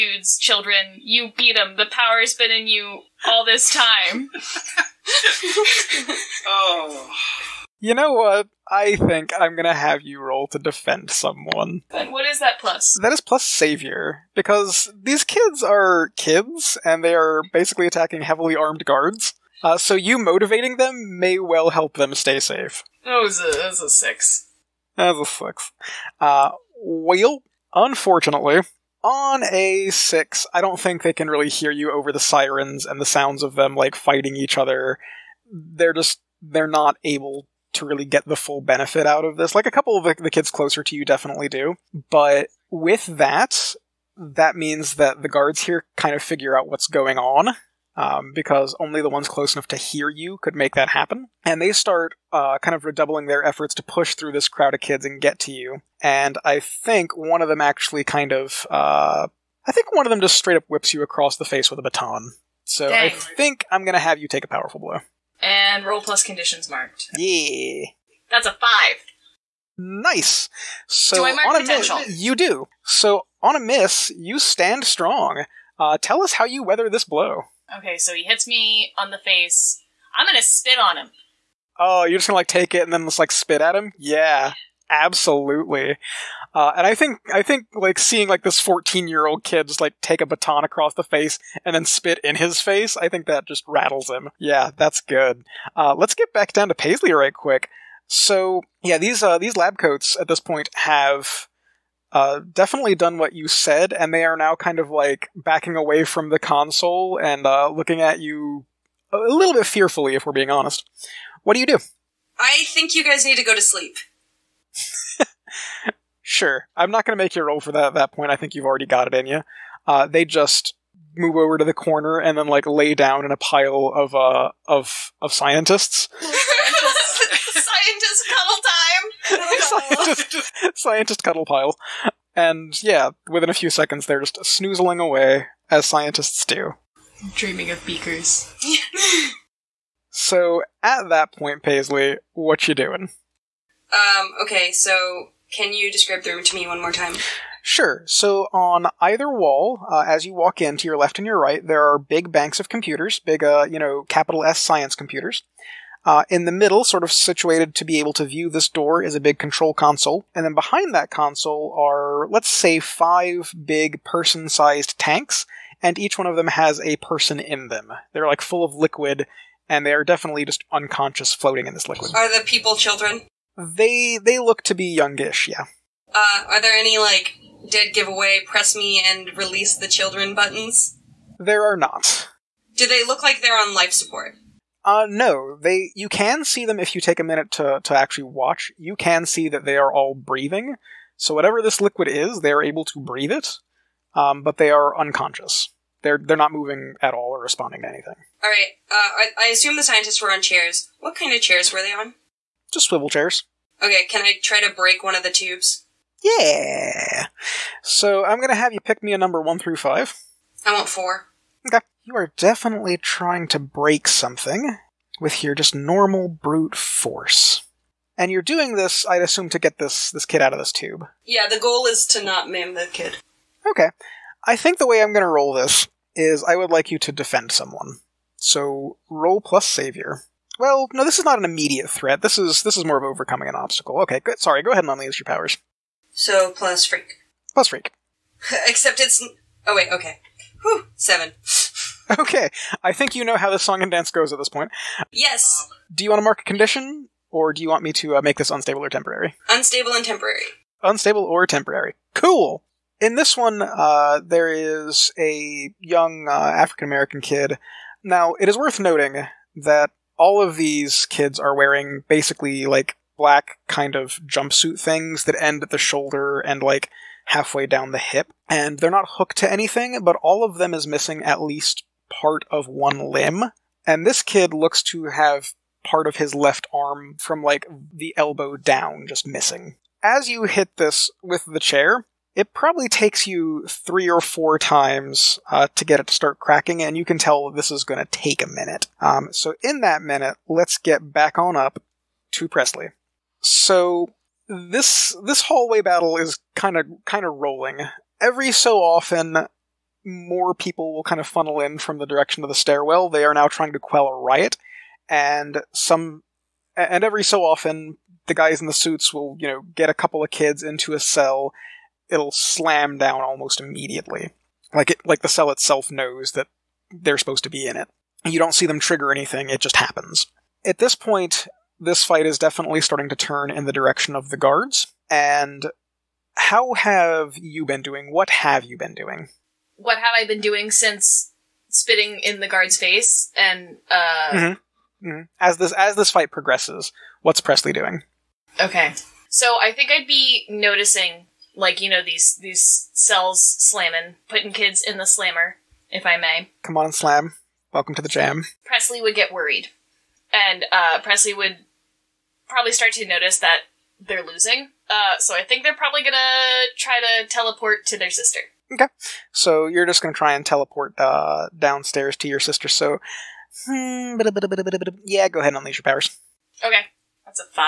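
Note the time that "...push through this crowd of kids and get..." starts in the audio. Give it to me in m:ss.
0:53.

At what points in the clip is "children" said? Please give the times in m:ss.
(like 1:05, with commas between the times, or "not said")
0:00, 2:52, 2:59.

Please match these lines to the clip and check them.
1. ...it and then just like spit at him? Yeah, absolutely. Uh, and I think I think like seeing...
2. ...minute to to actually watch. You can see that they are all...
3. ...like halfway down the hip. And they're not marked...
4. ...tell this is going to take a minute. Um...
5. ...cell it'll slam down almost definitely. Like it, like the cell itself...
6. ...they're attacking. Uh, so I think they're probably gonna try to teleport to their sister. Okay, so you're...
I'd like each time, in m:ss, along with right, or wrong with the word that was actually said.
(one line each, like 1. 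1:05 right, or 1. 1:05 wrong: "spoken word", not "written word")
1. 1:22 right
2. 3:07 right
3. 4:26 wrong: "hooked", not "marked"
4. 4:47 right
5. 5:11 wrong: "immediately", not "definitely"
6. 5:53 wrong: "losing", not "attacking".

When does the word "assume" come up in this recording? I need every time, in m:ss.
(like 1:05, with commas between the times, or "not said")
3:19, 3:39.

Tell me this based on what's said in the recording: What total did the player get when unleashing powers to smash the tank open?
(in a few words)
7.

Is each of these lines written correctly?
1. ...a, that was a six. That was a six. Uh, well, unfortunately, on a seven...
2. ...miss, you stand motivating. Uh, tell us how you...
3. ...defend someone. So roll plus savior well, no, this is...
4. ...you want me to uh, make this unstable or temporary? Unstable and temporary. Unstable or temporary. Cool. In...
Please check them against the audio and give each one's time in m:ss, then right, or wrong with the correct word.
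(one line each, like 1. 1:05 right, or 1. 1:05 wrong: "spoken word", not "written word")
1. 0:23 wrong: "six", not "seven"
2. 1:13 wrong: "strong", not "motivating"
3. 3:47 right
4. 4:07 right.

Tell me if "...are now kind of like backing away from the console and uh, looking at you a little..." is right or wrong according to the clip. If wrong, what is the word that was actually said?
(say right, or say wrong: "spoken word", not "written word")
right.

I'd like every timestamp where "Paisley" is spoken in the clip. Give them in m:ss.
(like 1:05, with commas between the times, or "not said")
1:36, 2:21.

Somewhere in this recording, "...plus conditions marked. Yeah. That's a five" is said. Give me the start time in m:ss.
1:06.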